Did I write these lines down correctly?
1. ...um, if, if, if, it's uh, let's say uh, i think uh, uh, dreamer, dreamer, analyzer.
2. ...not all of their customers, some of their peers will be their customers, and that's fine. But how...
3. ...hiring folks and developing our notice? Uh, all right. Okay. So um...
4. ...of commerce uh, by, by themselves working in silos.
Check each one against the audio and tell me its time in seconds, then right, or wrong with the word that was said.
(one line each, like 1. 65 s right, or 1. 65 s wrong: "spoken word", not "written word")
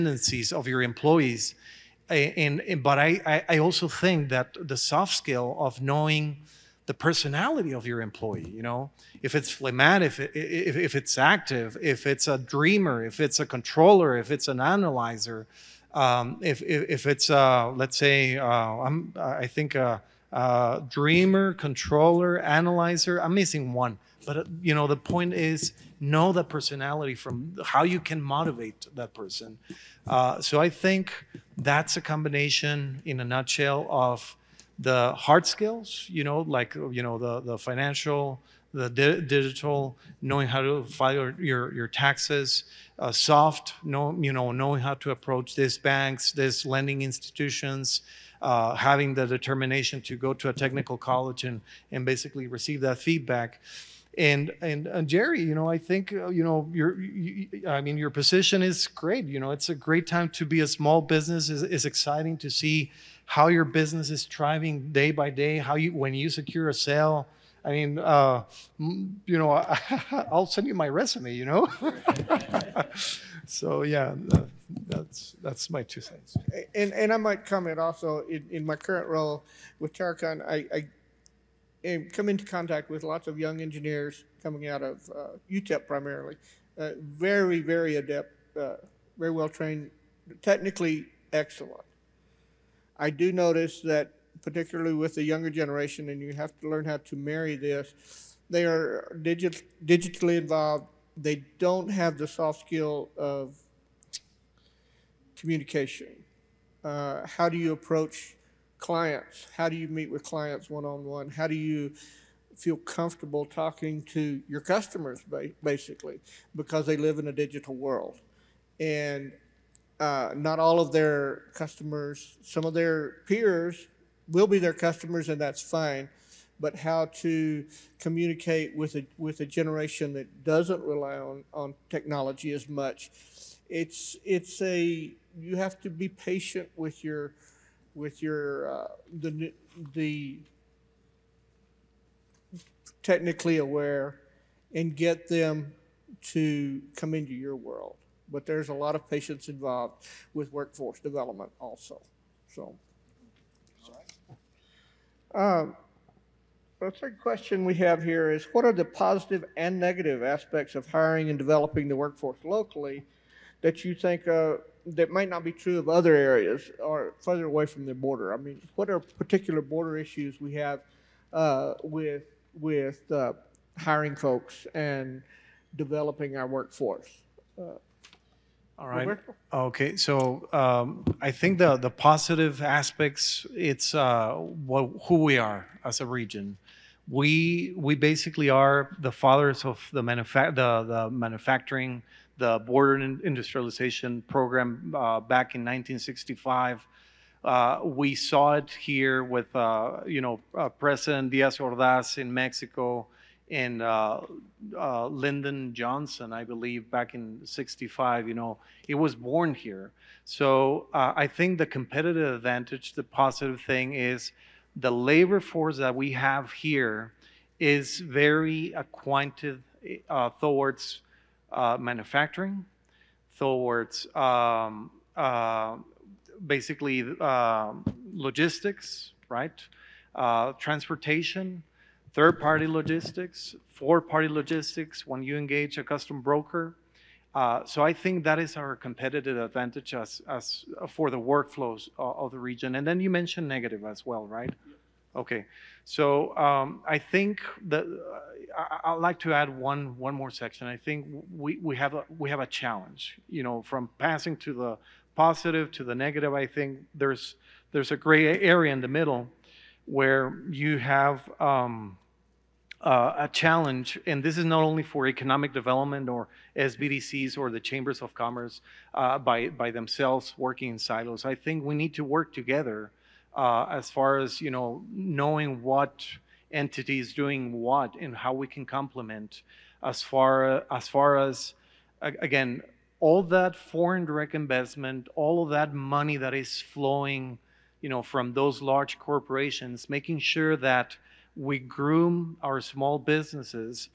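1. 15 s wrong: "controller", not "dreamer"
2. 120 s right
3. 173 s wrong: "workforce", not "notice"
4. 268 s right.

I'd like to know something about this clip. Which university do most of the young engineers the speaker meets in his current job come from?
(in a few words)
UTEP.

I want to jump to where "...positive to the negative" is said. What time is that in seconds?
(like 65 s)
255 s.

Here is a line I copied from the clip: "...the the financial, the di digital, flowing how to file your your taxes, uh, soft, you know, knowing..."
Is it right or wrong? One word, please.
wrong.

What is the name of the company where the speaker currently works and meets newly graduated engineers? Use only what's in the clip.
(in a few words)
Terracon.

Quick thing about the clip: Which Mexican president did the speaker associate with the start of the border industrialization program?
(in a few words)
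Diaz Ordaz.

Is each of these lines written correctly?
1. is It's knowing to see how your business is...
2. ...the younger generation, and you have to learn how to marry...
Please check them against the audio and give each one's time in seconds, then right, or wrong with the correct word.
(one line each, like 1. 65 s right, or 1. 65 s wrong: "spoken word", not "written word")
1. 61 s wrong: "exciting", not "knowing"
2. 95 s right.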